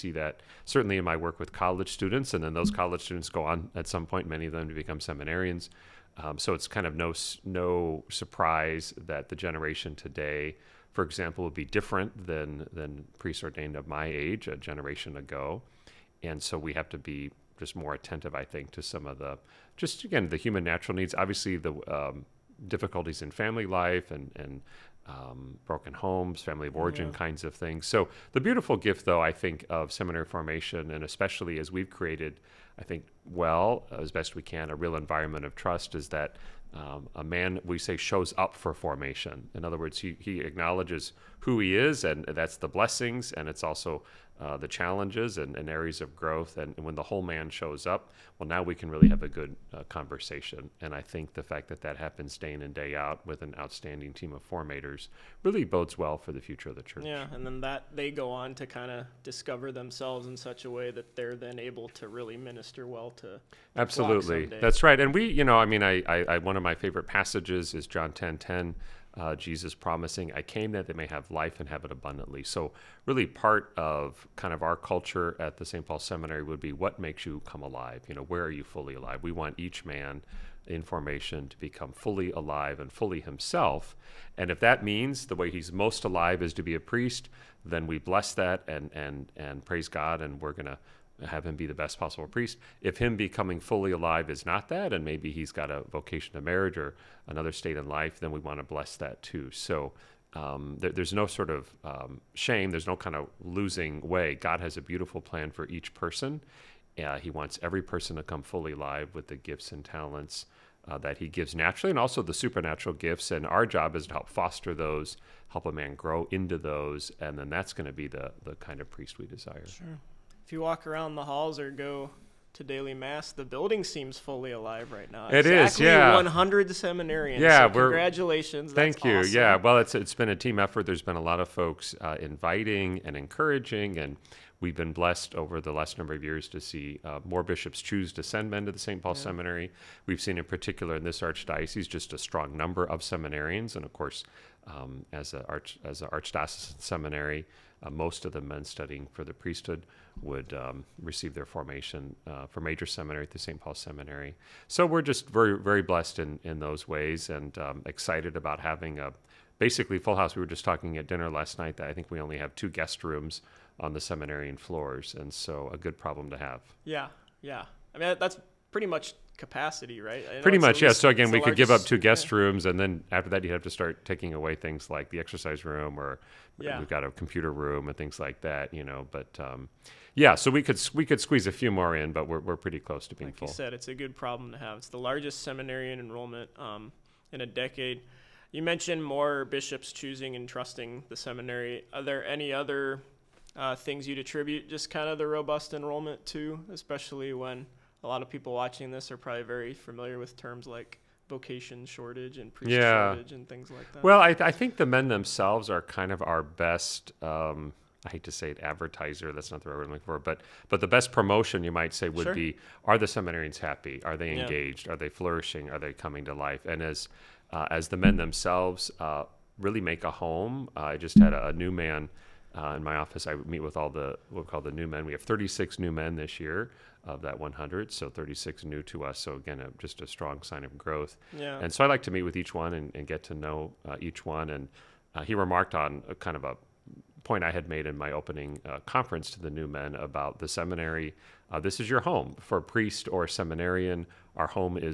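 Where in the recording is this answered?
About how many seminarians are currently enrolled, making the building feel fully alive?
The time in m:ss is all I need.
2:06.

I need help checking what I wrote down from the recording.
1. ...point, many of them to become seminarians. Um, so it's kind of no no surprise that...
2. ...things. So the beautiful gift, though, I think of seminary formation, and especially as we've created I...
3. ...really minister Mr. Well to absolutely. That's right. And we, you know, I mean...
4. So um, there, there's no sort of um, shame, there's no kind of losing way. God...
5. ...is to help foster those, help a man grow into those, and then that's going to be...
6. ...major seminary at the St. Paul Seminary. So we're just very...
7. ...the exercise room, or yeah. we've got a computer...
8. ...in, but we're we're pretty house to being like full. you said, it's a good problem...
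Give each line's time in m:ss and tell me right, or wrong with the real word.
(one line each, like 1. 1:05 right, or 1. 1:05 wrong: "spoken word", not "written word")
1. 0:04 right
2. 0:27 right
3. 1:02 right
4. 1:39 right
5. 1:53 right
6. 2:32 right
7. 2:55 right
8. 3:01 wrong: "close", not "house".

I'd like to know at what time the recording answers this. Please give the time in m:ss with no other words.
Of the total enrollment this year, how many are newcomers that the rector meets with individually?
3:45.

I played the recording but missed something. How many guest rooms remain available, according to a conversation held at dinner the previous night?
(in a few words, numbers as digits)
2.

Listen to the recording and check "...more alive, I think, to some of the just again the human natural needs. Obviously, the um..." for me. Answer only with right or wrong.
wrong.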